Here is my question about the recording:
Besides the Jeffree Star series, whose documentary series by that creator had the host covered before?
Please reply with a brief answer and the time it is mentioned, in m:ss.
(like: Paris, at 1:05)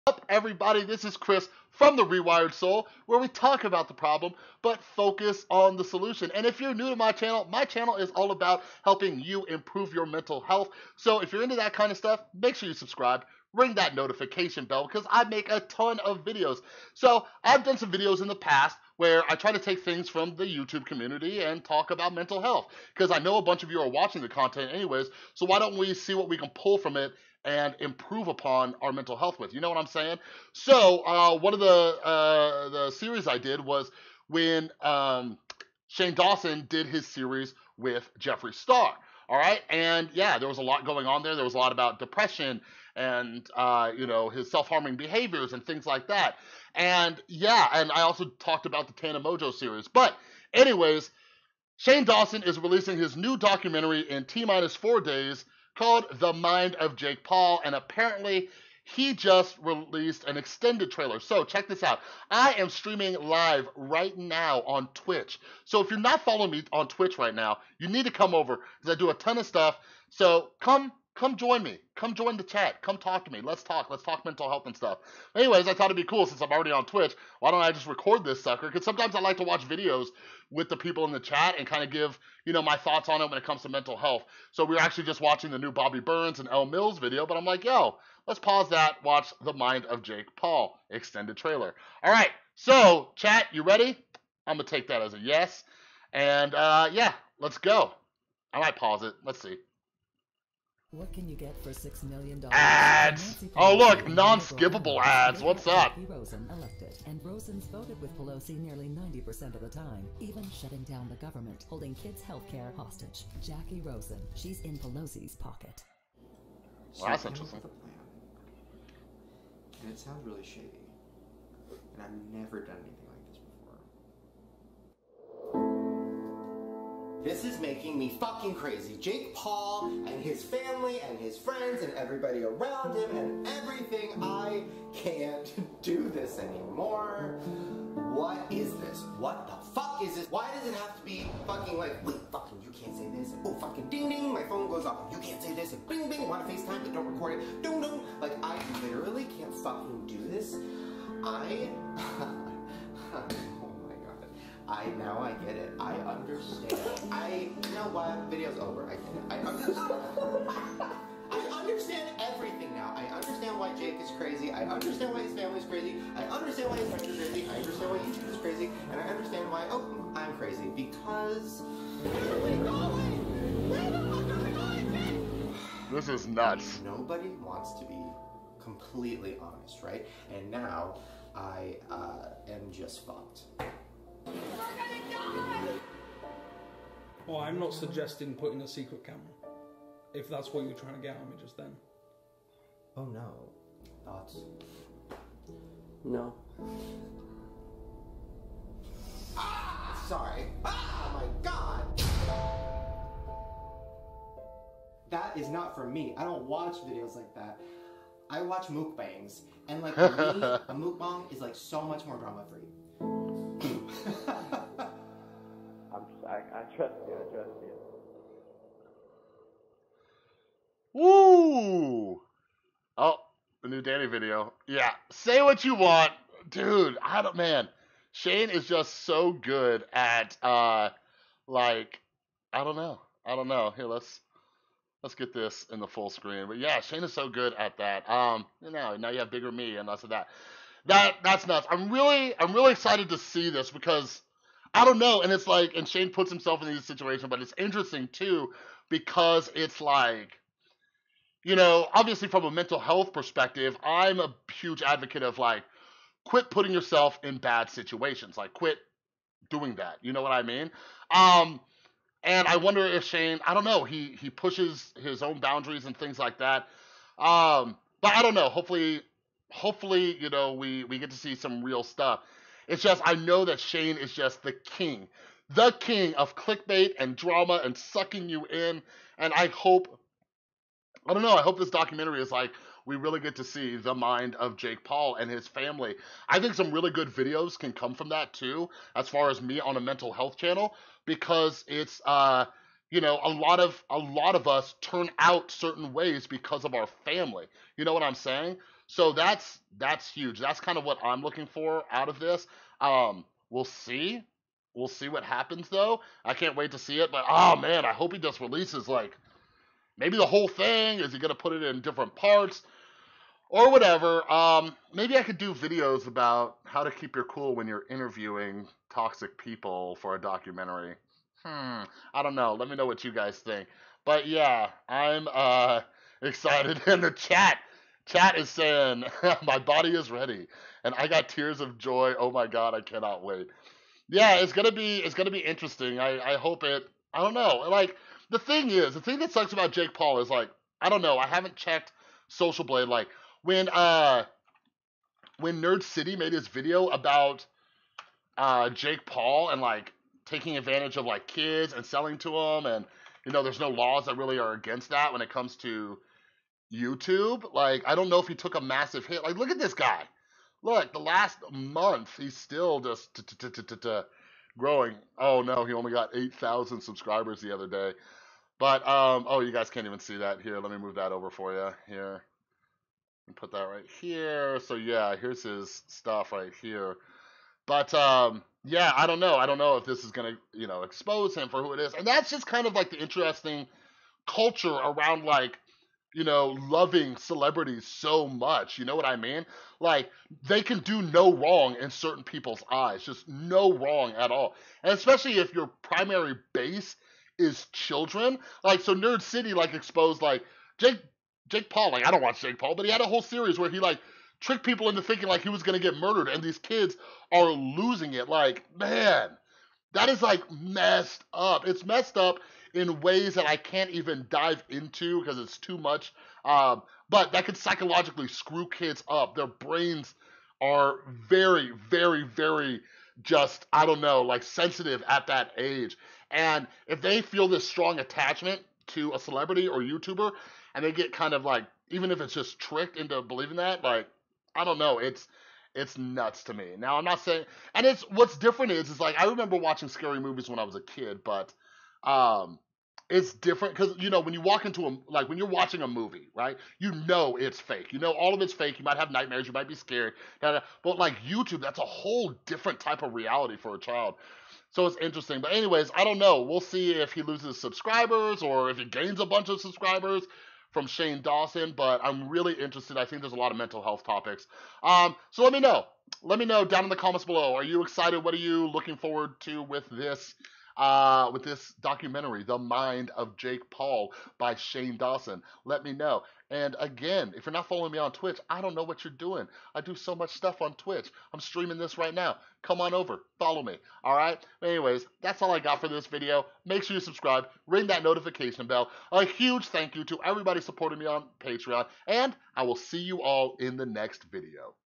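Tana Mongeau, at 0:48.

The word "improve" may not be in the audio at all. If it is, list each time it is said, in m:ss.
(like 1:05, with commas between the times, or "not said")
0:09, 0:27.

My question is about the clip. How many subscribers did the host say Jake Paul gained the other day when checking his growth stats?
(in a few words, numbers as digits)
8,000.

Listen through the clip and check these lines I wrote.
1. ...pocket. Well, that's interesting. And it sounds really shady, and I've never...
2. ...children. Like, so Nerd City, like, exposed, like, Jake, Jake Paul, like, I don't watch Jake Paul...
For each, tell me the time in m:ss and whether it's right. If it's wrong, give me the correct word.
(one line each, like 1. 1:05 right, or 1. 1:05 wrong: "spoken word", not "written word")
1. 1:55 right
2. 6:37 right.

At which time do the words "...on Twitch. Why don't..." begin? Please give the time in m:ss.
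1:16.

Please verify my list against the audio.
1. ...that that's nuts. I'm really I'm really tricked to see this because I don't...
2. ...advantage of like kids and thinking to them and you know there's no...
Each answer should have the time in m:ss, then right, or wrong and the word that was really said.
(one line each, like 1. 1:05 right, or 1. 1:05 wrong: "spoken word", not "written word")
1. 4:00 wrong: "excited", not "tricked"
2. 5:50 wrong: "selling", not "thinking".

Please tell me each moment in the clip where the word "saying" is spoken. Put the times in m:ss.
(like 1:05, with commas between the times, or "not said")
0:29, 4:58, 5:28, 7:17.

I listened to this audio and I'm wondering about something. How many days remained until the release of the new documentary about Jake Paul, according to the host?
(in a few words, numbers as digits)
4.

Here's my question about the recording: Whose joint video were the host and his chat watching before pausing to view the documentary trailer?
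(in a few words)
Bobby Burns and Elle Mills.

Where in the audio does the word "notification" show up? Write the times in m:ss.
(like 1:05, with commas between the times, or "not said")
0:13, 8:08.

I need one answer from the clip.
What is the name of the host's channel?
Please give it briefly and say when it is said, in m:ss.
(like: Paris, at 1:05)
The Rewired Soul, at 0:01.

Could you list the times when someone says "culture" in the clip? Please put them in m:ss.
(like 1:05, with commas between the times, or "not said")
6:24.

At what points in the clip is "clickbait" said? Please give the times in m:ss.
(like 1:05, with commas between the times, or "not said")
4:36.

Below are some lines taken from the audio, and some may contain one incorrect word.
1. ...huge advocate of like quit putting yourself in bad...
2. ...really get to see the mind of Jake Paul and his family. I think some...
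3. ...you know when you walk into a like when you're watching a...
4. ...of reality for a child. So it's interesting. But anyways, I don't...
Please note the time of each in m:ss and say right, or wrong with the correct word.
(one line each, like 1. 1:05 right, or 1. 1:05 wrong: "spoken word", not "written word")
1. 4:14 right
2. 4:42 right
3. 7:23 right
4. 7:33 right.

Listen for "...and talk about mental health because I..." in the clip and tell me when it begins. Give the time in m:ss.
0:21.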